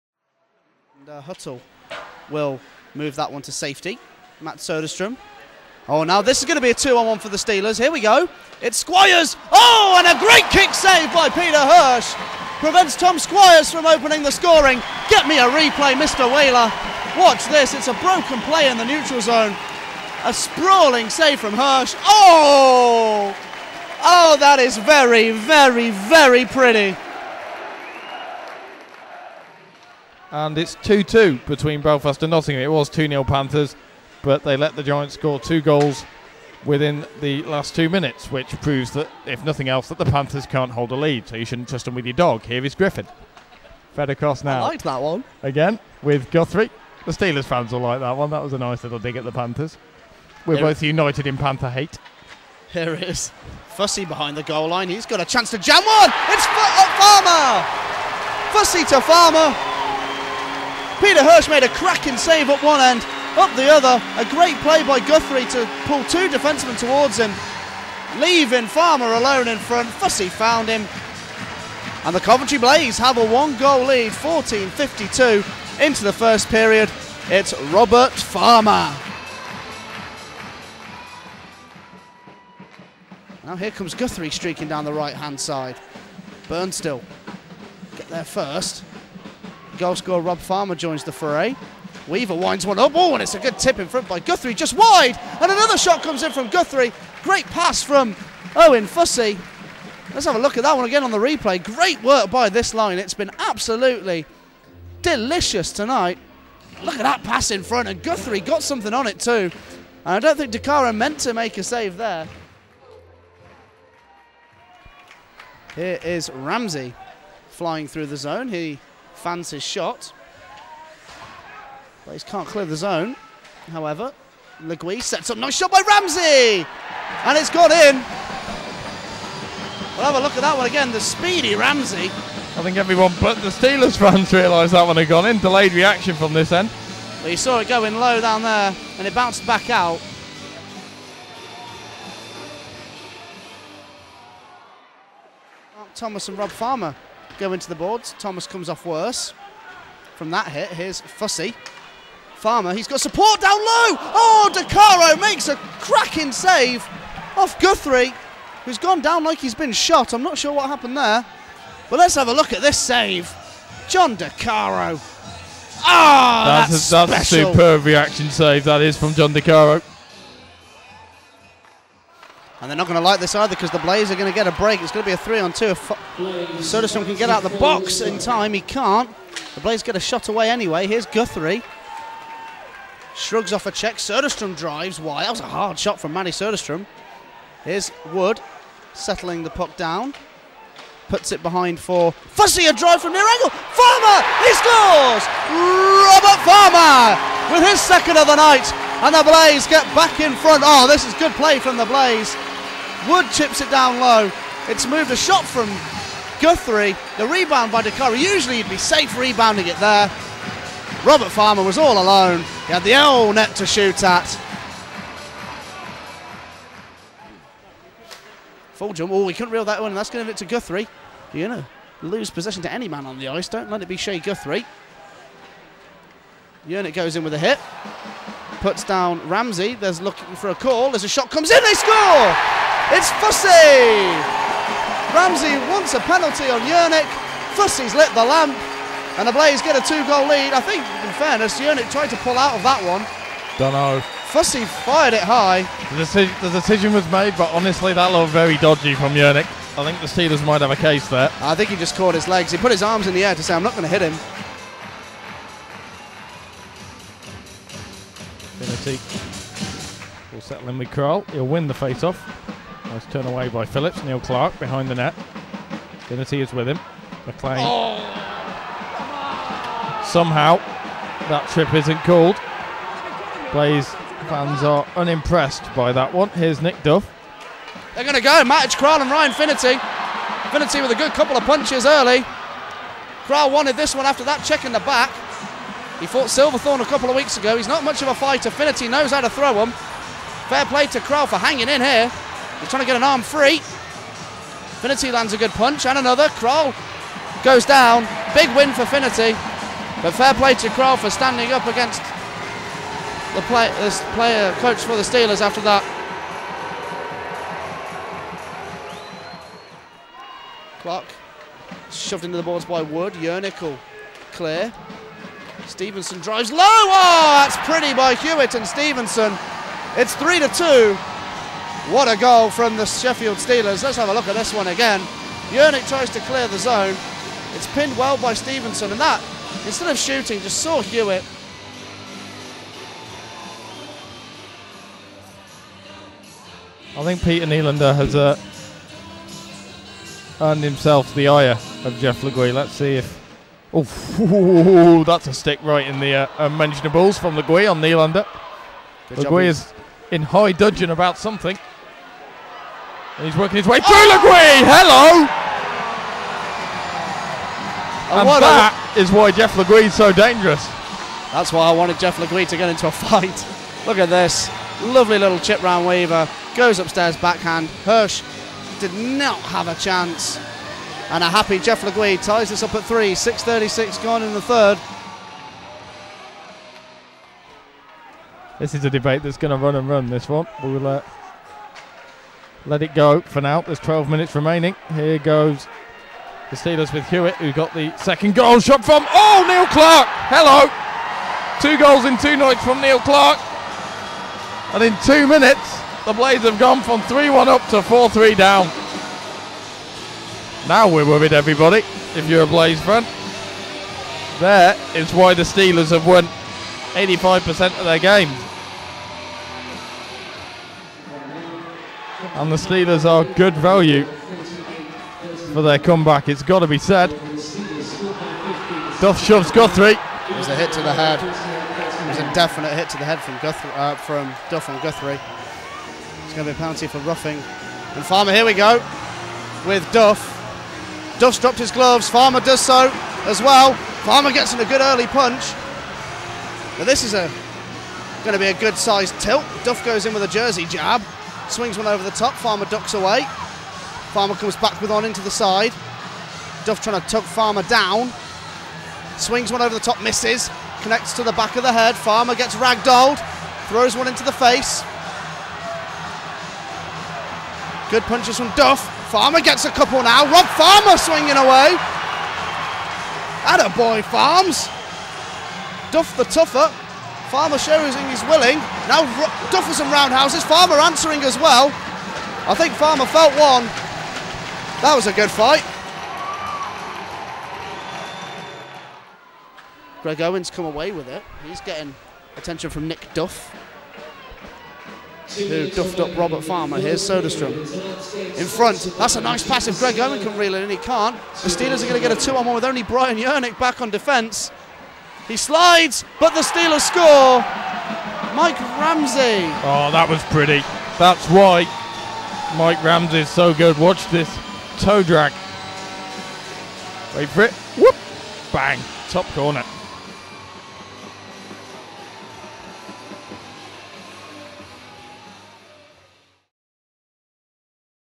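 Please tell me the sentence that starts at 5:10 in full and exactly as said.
Clock shoved into the boards by Wood.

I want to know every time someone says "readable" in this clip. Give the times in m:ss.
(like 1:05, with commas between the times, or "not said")
not said.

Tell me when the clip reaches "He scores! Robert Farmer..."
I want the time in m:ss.
3:14.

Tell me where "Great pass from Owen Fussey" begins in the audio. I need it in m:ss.
1:37.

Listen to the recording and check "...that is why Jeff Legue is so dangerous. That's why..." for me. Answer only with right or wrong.
right.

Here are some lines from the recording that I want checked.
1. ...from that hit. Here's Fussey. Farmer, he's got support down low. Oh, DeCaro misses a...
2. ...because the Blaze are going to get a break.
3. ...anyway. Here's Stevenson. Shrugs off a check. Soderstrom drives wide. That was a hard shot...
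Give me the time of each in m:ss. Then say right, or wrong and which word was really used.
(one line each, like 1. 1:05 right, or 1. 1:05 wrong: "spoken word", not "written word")
1. 2:30 wrong: "makes", not "misses"
2. 2:53 right
3. 3:00 wrong: "Guthrie", not "Stevenson".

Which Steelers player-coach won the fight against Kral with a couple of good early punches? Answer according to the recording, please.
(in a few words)
Ryan Finnerty.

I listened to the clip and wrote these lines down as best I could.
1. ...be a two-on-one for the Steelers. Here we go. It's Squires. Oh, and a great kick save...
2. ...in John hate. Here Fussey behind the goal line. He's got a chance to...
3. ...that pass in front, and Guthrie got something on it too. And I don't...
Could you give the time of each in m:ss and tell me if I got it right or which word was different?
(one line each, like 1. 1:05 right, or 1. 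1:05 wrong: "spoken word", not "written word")
1. 0:06 right
2. 0:51 wrong: "Panther", not "John"
3. 1:47 right.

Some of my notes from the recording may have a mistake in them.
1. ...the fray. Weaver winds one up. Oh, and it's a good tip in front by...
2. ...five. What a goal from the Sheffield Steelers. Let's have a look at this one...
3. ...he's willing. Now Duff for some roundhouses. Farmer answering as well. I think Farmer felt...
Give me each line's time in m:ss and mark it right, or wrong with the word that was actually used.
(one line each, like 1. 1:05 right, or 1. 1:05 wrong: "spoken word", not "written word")
1. 1:31 right
2. 5:20 wrong: "two", not "five"
3. 7:48 right.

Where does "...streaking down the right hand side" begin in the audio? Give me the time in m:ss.
1:24.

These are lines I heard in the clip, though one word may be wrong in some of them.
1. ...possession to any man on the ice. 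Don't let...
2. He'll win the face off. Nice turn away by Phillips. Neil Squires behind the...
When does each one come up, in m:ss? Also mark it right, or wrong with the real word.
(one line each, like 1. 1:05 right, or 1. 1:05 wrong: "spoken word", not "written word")
1. 3:42 right
2. 4:21 wrong: "Clark", not "Squires".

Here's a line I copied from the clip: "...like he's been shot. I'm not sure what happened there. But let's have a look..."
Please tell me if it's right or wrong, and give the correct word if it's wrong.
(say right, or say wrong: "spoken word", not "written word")
right.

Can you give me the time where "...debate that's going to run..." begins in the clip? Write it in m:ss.
6:18.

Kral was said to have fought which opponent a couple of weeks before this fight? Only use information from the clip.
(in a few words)
Silverthorne.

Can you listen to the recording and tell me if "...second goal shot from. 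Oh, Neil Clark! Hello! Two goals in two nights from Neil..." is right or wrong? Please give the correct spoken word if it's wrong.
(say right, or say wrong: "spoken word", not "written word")
right.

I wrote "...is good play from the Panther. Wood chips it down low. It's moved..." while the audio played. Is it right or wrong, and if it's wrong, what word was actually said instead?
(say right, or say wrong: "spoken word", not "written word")
wrong: "Blaze", not "Panther".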